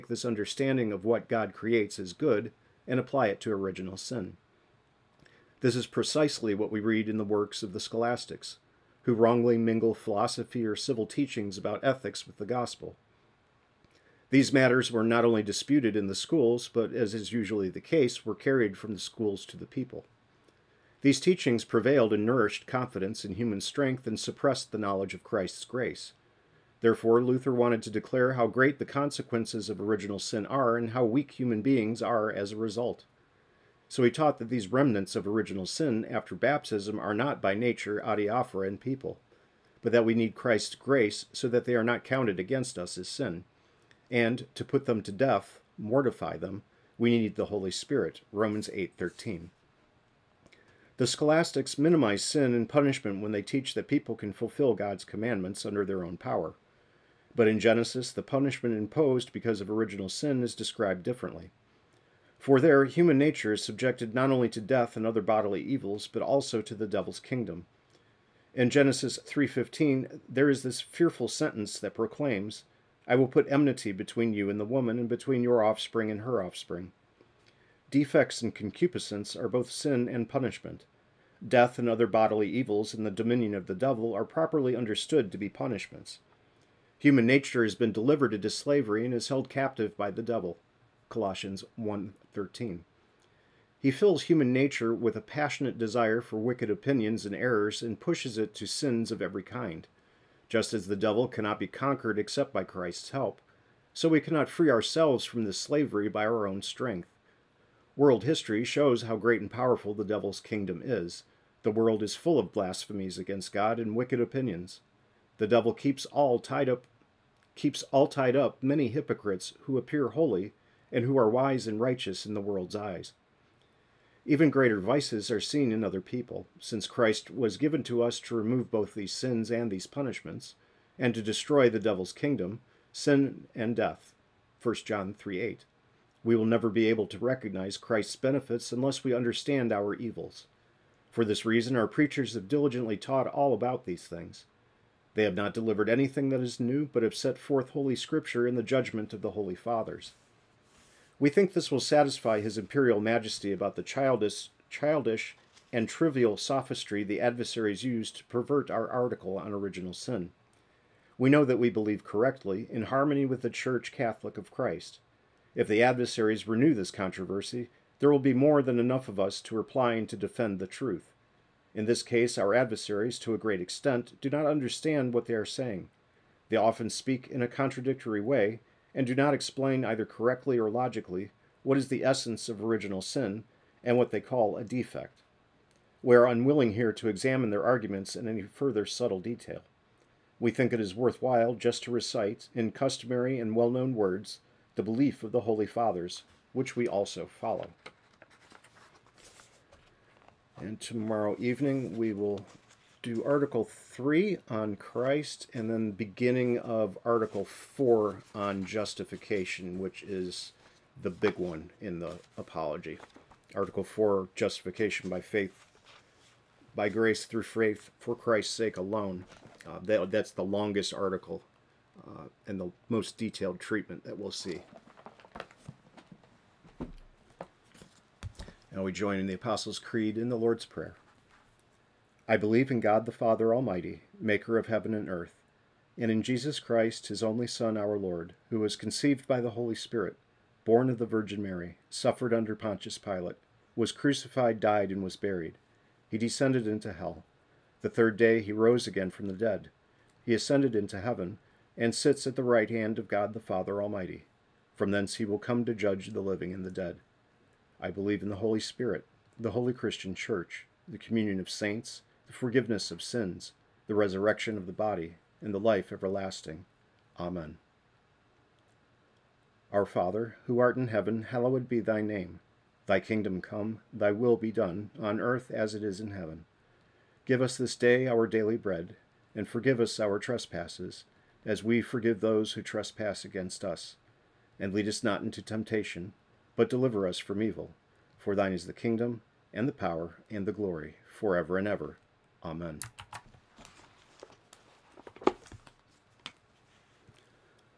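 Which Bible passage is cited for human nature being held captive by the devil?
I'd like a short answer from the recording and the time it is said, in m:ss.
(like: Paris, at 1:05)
Colossians 1:13, at 1:31.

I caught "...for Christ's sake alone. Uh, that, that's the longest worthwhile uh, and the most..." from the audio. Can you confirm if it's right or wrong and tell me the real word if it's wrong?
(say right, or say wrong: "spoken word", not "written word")
wrong: "article", not "worthwhile".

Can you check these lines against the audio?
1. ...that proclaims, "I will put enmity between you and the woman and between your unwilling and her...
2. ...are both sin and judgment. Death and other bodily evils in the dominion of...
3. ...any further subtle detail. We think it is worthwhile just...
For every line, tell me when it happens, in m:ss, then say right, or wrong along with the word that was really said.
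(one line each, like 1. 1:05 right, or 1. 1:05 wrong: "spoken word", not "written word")
1. 1:11 wrong: "offspring", not "unwilling"
2. 1:19 wrong: "punishment", not "judgment"
3. 3:08 right.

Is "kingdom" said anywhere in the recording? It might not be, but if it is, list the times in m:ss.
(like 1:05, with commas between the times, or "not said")
1:07, 1:50, 2:12, 4:32, 4:48.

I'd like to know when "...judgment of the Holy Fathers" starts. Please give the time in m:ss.
2:28.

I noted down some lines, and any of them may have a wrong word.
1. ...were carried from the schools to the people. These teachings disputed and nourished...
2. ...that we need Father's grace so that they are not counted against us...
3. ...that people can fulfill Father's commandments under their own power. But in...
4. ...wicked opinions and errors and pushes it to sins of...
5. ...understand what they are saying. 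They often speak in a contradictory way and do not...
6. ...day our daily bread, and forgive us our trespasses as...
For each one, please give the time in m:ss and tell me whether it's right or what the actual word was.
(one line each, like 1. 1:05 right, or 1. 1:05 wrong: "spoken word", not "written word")
1. 0:18 wrong: "prevailed", not "disputed"
2. 0:39 wrong: "Christ", not "Father"
3. 0:53 wrong: "God", not "Father"
4. 1:36 right
5. 2:54 right
6. 4:37 right.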